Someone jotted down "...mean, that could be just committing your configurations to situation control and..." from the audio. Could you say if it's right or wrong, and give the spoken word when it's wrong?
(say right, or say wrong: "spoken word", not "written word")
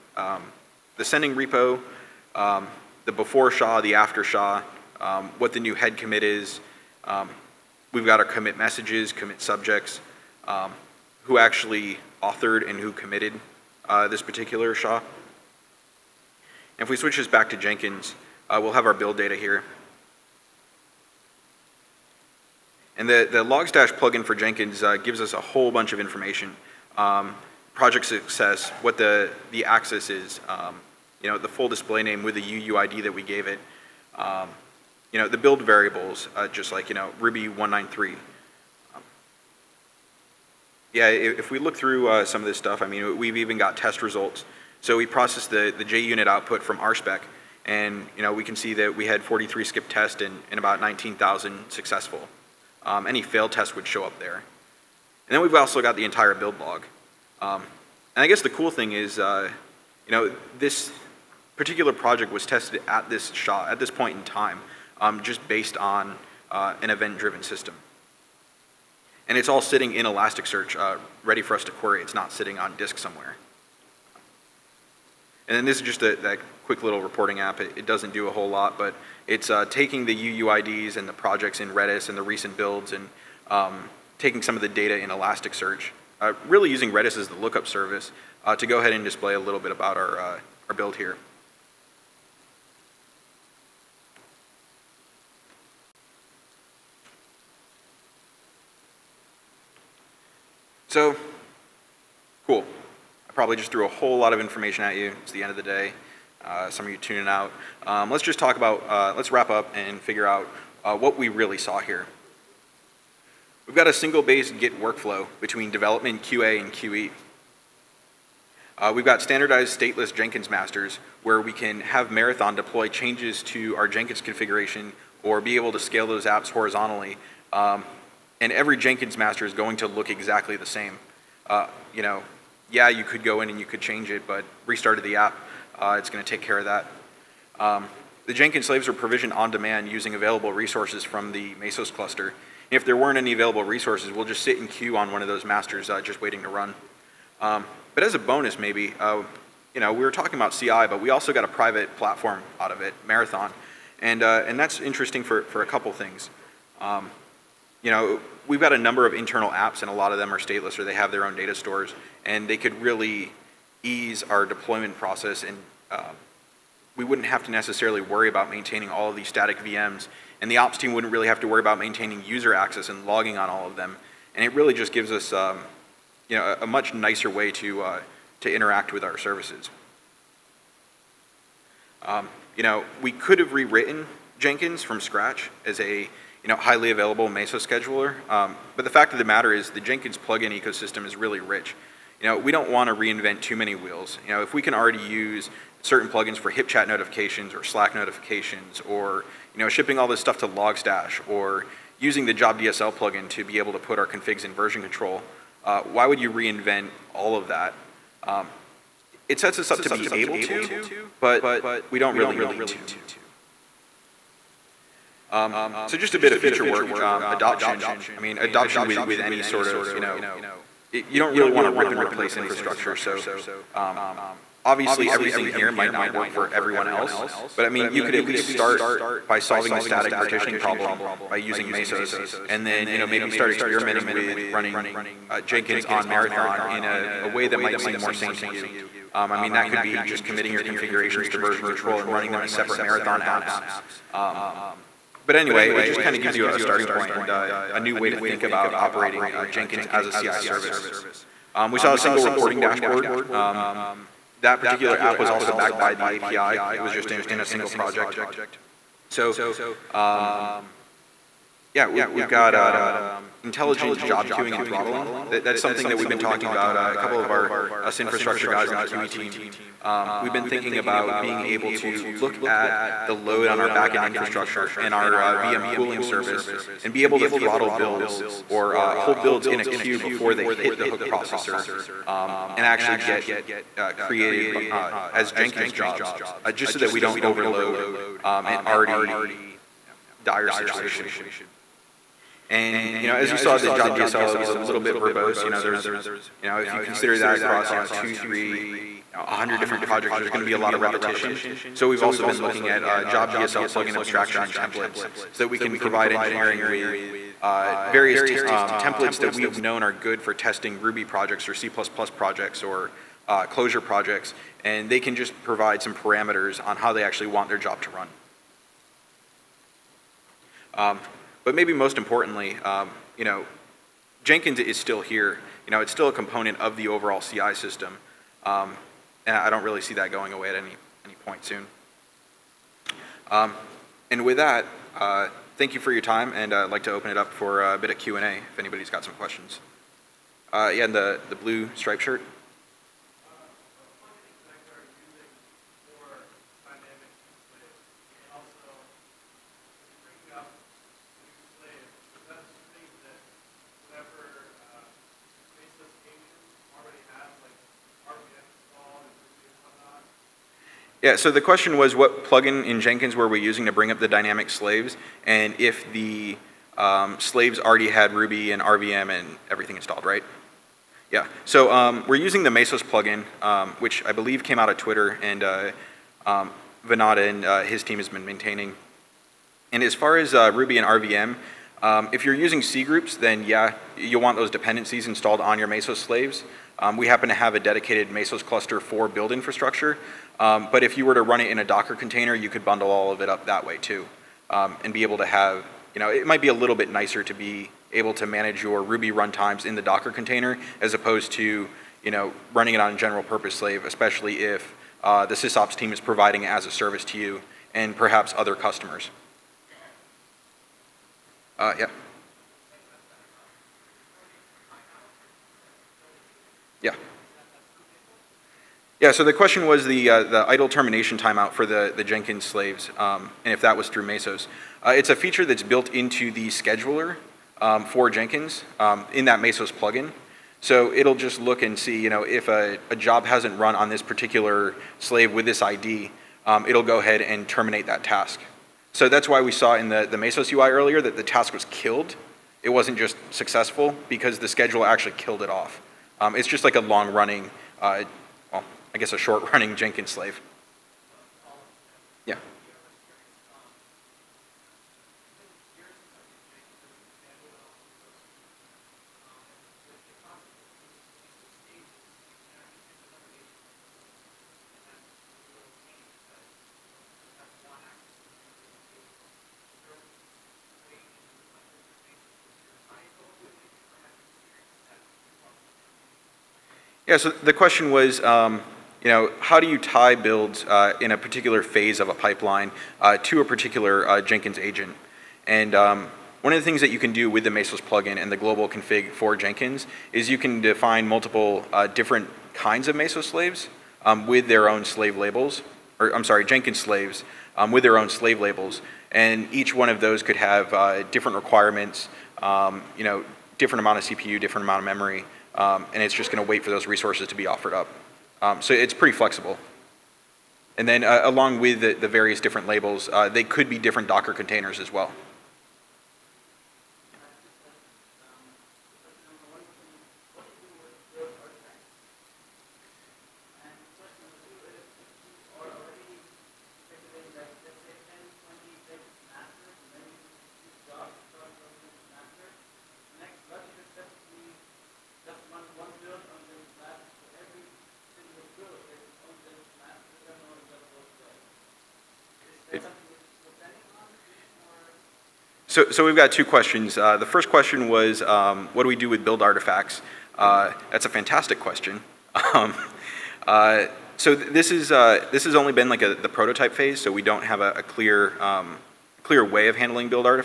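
wrong: "version", not "situation".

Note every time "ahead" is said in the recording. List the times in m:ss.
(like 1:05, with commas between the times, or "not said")
1:28, 7:16.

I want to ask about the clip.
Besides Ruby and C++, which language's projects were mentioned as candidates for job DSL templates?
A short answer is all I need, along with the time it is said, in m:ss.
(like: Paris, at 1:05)
Clojure, at 5:13.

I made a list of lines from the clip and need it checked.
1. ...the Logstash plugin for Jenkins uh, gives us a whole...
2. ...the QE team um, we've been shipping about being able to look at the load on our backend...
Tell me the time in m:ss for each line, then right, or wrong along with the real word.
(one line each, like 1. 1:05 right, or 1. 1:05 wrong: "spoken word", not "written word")
1. 0:23 right
2. 4:28 wrong: "thinking", not "shipping".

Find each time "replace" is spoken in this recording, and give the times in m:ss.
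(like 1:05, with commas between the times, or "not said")
3:41.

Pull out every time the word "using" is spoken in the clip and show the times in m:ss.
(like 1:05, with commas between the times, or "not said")
1:26, 2:19, 3:21, 3:51, 6:03, 6:12, 6:22.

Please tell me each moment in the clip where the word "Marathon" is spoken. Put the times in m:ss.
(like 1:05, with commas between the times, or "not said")
2:02, 2:33, 3:56, 4:02.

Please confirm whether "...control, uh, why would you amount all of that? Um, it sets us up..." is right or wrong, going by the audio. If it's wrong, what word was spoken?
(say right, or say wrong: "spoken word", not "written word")
wrong: "reinvent", not "amount".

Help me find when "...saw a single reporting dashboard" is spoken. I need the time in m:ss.
4:11.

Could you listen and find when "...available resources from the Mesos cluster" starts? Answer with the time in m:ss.
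2:20.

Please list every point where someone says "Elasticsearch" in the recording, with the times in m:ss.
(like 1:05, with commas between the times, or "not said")
1:10, 1:25.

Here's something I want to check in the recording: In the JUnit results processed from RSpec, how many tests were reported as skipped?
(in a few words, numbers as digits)
43.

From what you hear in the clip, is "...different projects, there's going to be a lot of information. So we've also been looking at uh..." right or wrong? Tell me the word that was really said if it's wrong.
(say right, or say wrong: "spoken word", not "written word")
wrong: "repetition", not "information".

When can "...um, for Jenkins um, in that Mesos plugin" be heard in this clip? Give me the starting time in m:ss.
7:07.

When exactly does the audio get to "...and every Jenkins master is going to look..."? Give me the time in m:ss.
2:08.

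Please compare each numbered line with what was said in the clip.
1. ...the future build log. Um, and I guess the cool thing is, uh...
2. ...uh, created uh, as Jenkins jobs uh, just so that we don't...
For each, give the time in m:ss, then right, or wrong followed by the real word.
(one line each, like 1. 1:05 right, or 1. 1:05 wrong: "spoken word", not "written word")
1. 0:55 wrong: "entire", not "future"
2. 4:43 right.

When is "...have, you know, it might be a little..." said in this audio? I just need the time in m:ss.
6:35.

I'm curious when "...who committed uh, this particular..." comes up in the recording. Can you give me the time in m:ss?
0:12.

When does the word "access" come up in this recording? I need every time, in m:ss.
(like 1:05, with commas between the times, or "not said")
0:29, 2:52.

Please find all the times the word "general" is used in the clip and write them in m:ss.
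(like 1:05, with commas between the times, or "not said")
6:42.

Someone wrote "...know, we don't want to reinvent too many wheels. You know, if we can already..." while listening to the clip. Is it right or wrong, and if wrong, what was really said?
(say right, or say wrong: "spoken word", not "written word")
right.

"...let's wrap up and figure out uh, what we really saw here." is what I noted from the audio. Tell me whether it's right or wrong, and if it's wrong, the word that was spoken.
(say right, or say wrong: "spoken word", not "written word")
right.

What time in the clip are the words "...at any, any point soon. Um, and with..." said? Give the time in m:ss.
5:30.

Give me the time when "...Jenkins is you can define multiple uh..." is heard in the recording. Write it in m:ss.
8:09.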